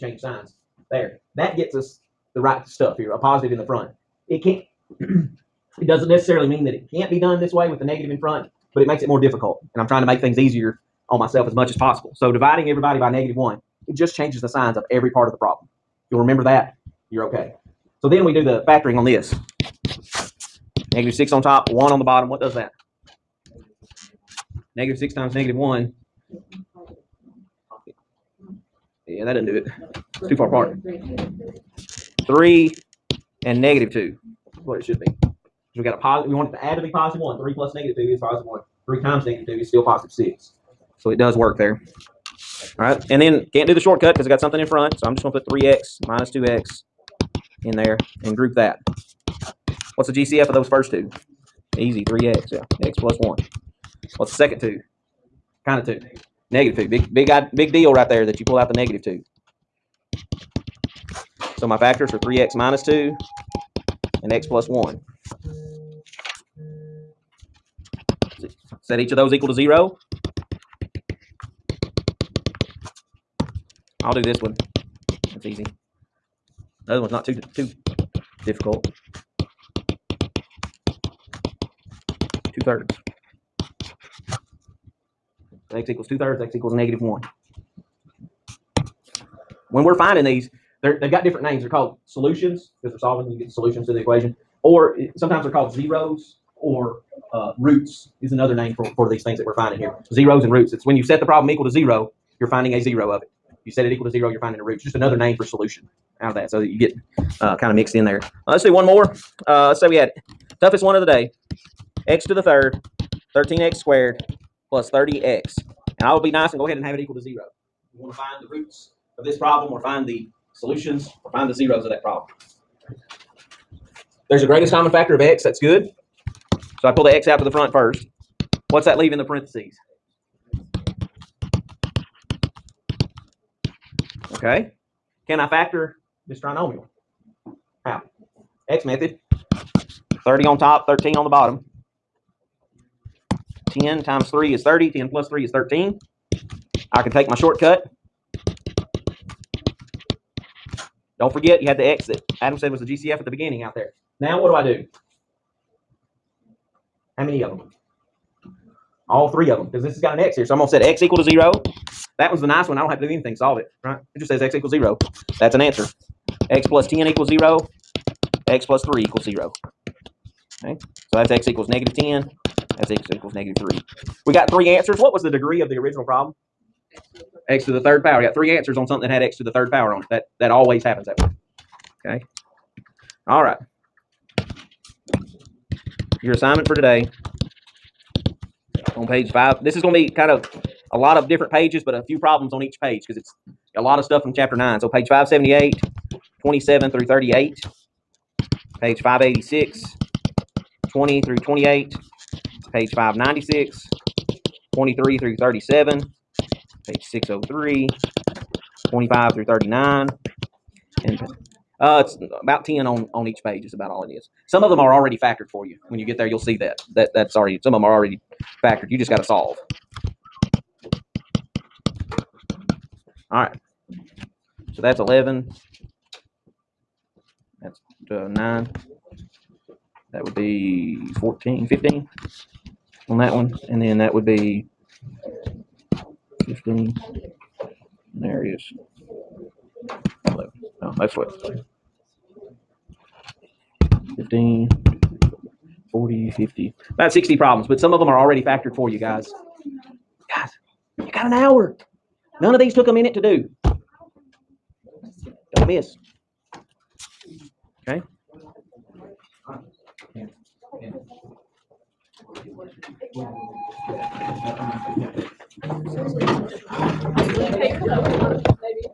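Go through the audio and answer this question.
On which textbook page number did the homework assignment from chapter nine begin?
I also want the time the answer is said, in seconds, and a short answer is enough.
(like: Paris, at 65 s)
578, at 195 s.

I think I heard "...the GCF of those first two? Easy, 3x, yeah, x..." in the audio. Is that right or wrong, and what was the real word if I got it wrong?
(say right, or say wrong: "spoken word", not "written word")
right.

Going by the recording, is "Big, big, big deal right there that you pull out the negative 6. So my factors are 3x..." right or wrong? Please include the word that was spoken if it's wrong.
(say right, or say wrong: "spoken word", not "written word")
wrong: "2", not "6".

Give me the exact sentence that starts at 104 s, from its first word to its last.
It's just another name for solution out of that.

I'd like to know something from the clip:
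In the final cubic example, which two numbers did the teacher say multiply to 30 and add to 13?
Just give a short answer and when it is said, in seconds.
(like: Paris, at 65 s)
10 and 3, at 143 s.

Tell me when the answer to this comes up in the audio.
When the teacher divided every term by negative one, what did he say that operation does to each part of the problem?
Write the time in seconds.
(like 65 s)
14 s.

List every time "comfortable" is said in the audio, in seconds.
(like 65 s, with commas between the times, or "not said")
not said.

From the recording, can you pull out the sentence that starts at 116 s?
And I will be nice and go ahead and have it equal to zero.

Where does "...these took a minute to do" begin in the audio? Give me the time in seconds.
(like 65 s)
252 s.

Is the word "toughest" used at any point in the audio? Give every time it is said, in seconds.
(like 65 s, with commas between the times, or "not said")
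110 s.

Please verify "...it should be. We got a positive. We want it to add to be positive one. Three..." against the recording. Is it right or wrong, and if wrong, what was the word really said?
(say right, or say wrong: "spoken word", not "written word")
right.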